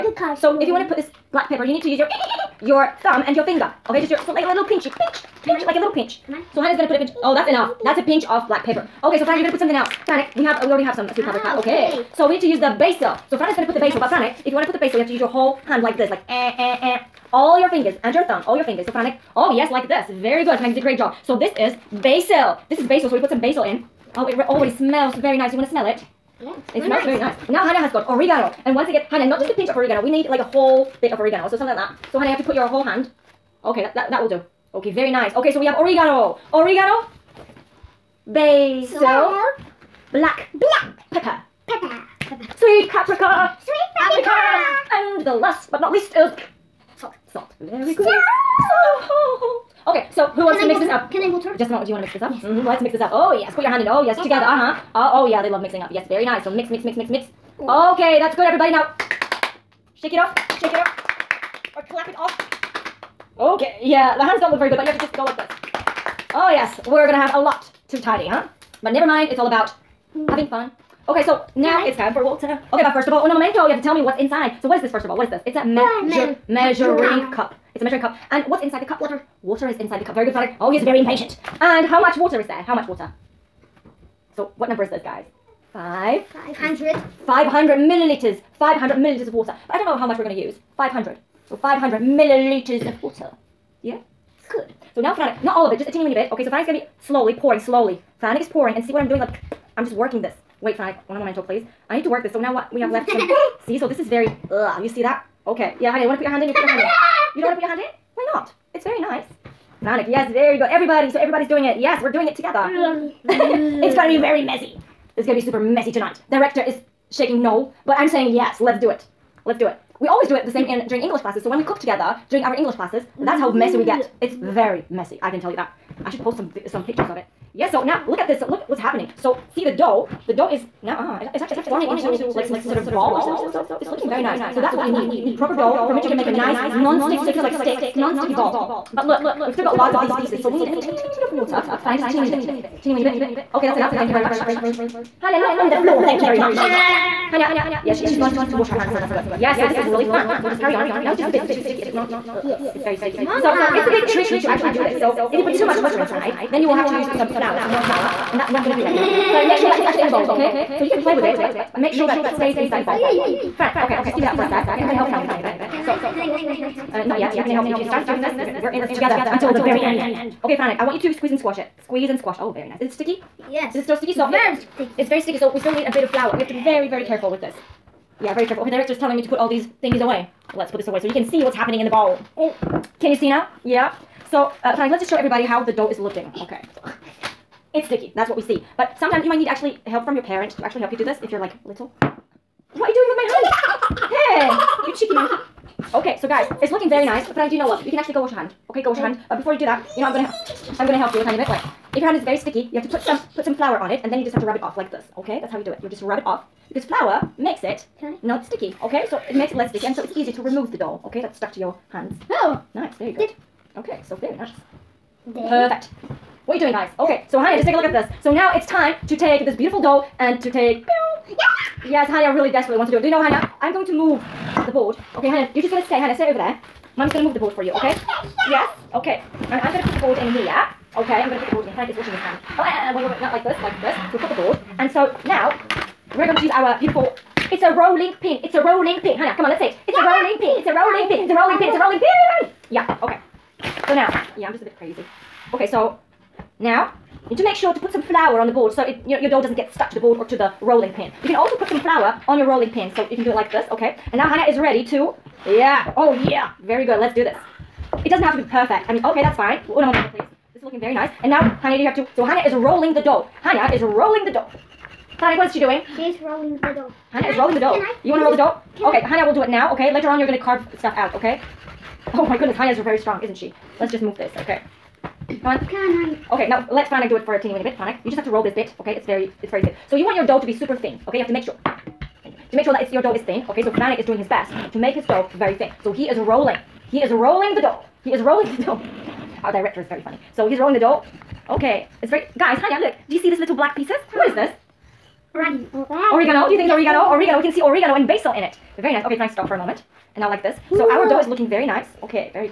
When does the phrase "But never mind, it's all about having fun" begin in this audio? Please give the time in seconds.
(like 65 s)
68 s.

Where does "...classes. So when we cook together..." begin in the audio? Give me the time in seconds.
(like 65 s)
121 s.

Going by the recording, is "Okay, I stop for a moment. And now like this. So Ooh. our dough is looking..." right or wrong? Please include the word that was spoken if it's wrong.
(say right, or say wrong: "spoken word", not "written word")
right.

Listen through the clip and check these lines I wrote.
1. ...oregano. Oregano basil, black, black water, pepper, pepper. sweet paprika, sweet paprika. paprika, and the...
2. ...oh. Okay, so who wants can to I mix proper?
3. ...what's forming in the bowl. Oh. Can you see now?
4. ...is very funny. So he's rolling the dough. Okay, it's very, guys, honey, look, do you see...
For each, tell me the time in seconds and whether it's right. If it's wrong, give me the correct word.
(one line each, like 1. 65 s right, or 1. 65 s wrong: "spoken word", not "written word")
1. 35 s wrong: "pepper", not "water"
2. 49 s wrong: "water", not "proper"
3. 181 s wrong: "happening", not "forming"
4. 289 s right.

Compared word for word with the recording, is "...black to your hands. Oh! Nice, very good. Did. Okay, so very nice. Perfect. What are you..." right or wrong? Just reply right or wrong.
wrong.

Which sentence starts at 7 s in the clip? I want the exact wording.
That's a pinch of black pepper.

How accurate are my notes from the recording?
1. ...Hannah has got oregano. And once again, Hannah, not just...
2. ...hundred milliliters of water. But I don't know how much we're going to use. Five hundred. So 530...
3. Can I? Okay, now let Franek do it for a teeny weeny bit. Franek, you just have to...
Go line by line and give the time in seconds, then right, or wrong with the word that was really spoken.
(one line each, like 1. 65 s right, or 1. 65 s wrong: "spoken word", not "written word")
1. 27 s right
2. 88 s wrong: "500", not "530"
3. 275 s right.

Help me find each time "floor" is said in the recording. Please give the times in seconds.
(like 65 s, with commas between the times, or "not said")
145 s.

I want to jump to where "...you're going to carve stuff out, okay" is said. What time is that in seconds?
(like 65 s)
270 s.